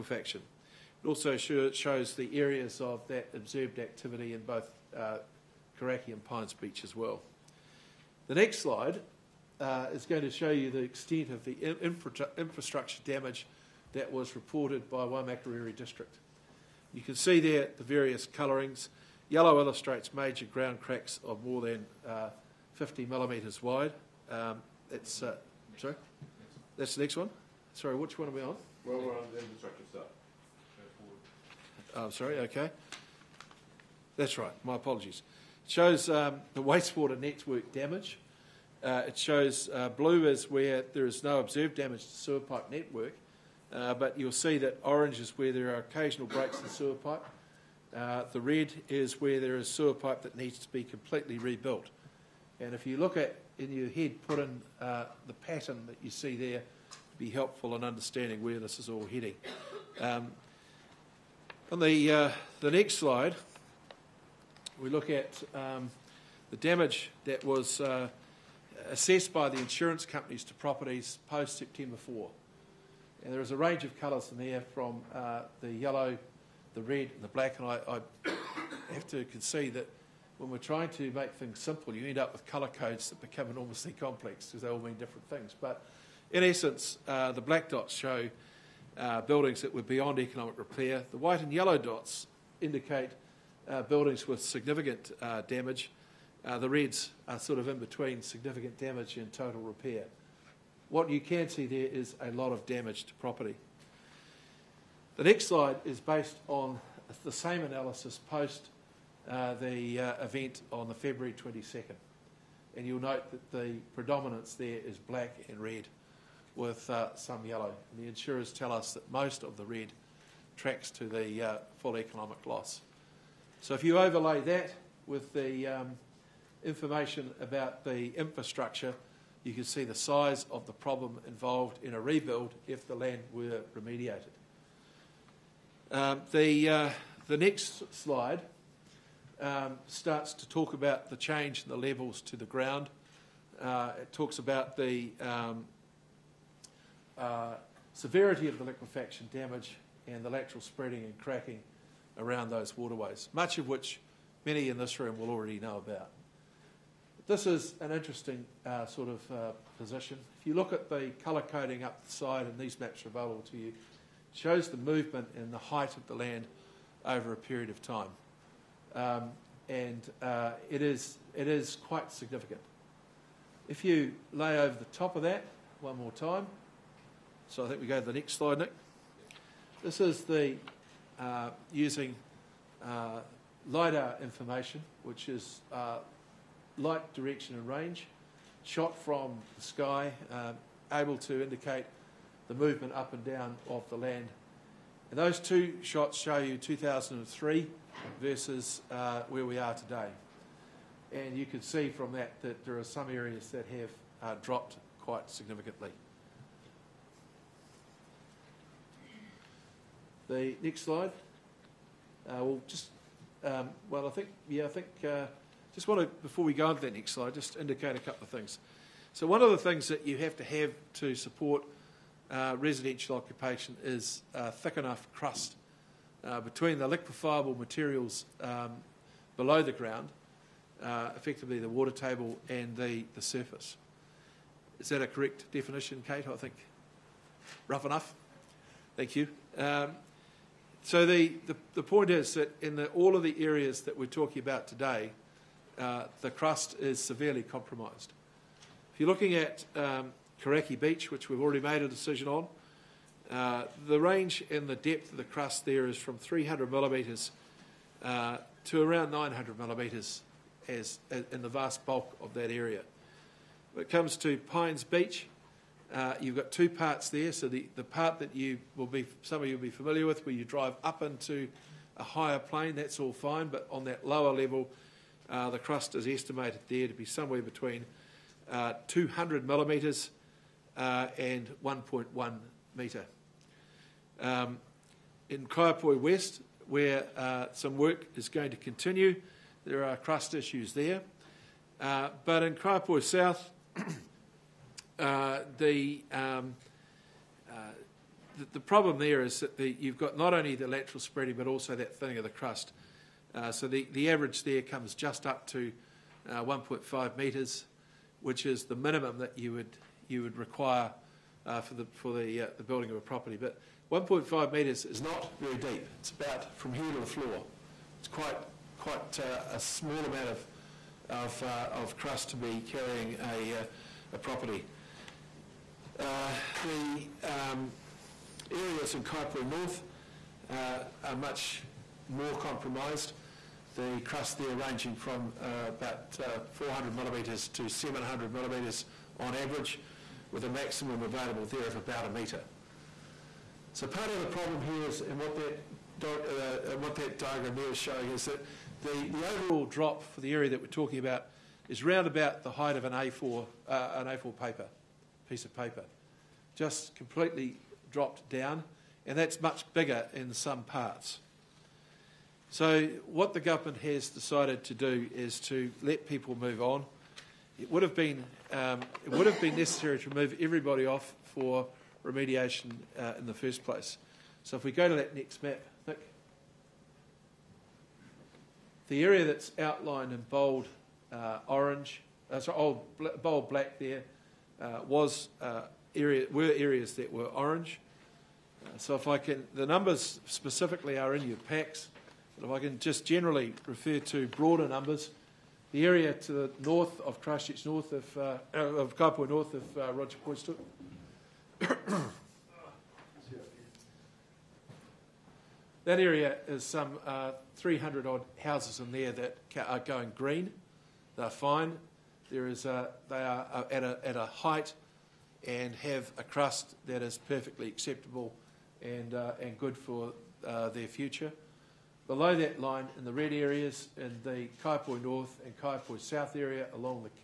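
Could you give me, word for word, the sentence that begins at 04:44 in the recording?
Um, in Kaiapoi West, where uh, some work is going to continue, there are crust issues there.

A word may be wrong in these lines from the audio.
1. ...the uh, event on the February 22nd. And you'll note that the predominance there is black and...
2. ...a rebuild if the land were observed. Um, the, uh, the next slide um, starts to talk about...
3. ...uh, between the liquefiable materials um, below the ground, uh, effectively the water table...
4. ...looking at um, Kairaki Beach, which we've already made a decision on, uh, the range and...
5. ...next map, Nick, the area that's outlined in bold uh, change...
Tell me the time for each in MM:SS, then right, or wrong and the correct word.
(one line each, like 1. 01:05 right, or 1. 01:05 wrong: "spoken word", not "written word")
1. 01:49 right
2. 02:11 wrong: "remediated", not "observed"
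3. 03:46 right
4. 04:09 right
5. 06:15 wrong: "orange", not "change".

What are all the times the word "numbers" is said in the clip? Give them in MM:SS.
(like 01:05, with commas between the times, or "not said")
06:29, 06:34.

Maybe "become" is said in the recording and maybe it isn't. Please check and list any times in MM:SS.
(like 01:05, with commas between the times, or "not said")
01:23.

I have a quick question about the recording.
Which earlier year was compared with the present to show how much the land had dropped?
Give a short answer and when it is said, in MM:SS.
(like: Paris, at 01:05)
2003, at 03:16.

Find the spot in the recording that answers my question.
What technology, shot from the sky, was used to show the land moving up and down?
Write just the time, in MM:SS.
03:03.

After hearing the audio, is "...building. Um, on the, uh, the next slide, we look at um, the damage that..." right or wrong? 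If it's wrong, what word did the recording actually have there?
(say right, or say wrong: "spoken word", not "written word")
wrong: "heading", not "building".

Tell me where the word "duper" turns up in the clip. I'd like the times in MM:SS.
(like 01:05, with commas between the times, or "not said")
not said.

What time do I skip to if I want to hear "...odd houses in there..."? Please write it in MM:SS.
06:48.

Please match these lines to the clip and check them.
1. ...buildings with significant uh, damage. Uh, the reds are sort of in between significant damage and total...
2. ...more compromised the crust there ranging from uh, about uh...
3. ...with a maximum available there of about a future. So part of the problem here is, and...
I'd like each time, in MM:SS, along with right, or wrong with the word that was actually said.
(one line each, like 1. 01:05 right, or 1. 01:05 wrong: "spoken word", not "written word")
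1. 01:33 right
2. 05:32 right
3. 05:40 wrong: "metre", not "future".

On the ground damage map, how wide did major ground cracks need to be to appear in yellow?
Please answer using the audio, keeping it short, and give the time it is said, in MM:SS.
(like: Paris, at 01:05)
50 millimetres, at 00:22.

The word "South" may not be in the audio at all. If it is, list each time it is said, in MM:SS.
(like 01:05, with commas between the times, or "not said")
04:53, 07:05.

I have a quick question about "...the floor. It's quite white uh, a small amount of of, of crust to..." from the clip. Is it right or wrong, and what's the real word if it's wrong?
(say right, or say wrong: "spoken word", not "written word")
wrong: "quite", not "white".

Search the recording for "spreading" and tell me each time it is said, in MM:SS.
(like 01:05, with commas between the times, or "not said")
02:30, 05:00.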